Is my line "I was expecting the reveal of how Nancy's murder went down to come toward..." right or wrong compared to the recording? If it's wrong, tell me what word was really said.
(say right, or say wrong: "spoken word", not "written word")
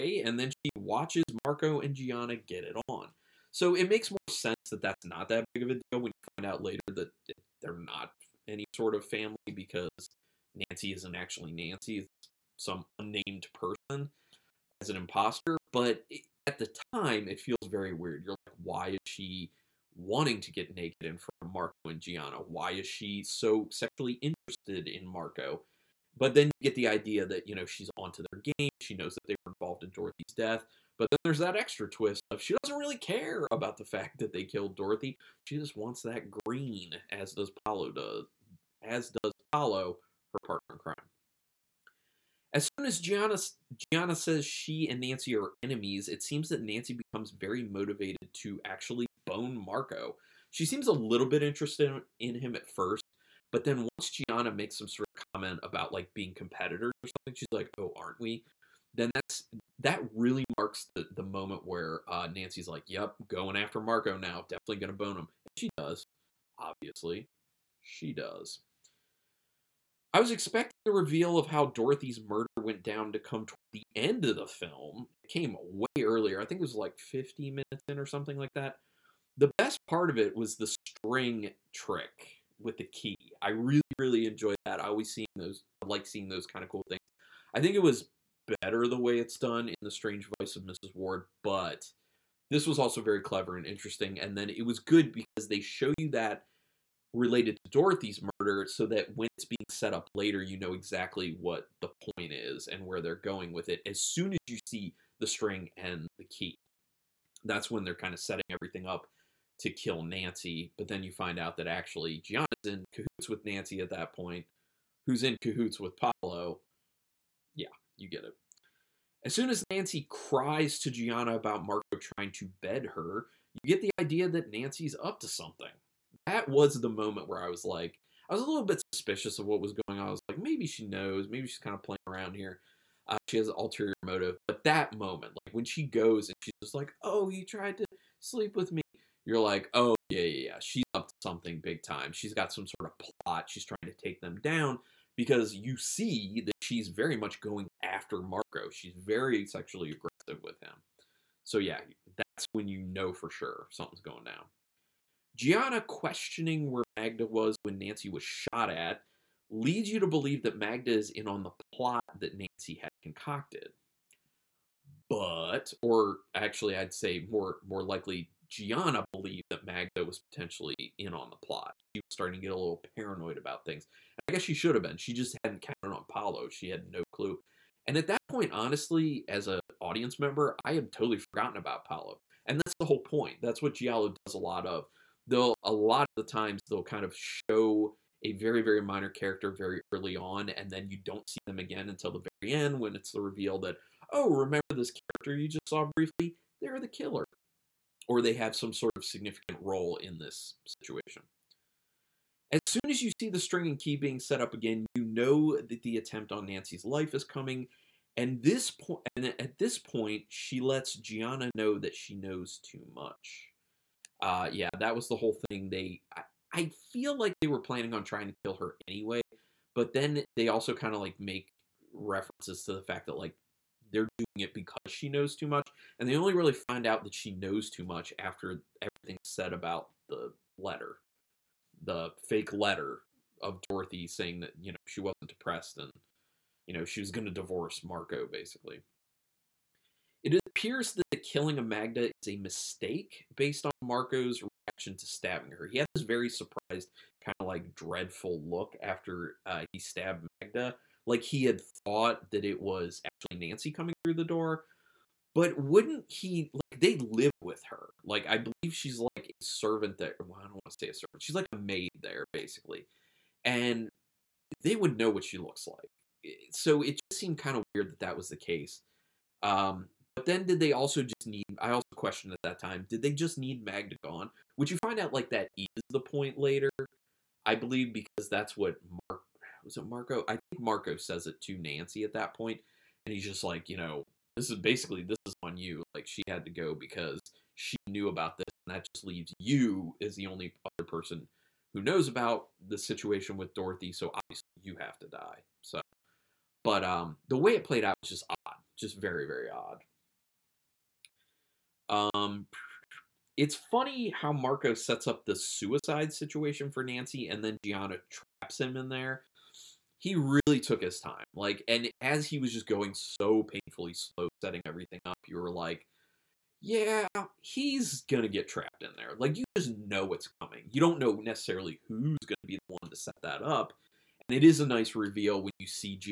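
wrong: "Dorothy", not "Nancy".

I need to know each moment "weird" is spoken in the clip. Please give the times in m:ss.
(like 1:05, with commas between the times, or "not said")
0:17, 4:27.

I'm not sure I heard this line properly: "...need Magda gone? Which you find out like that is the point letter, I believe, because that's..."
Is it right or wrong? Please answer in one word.
wrong.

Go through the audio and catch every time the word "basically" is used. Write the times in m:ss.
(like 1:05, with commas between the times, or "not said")
3:58, 4:22, 4:44.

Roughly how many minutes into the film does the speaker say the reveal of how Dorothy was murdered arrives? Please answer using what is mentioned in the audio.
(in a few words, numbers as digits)
50.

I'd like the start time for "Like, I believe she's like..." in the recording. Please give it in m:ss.
4:18.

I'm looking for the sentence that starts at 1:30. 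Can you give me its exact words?
Ward, but this was also very clever and interesting.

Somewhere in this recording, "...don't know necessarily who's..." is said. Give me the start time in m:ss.
5:20.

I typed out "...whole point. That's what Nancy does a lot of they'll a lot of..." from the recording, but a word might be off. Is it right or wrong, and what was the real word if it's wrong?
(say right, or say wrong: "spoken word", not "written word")
wrong: "Giallo", not "Nancy".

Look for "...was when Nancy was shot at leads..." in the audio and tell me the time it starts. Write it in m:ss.
2:37.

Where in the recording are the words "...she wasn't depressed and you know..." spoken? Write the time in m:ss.
3:54.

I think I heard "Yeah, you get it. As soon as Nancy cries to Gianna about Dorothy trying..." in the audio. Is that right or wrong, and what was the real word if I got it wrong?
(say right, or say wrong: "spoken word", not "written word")
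wrong: "Marco", not "Dorothy".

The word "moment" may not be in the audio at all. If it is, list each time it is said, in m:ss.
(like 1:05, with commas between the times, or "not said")
1:01, 2:06, 2:14.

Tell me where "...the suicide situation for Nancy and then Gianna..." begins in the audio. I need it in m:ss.
5:05.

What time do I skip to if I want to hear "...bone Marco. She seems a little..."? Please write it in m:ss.
0:49.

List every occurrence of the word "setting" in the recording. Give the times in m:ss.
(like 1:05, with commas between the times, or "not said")
1:48, 5:14.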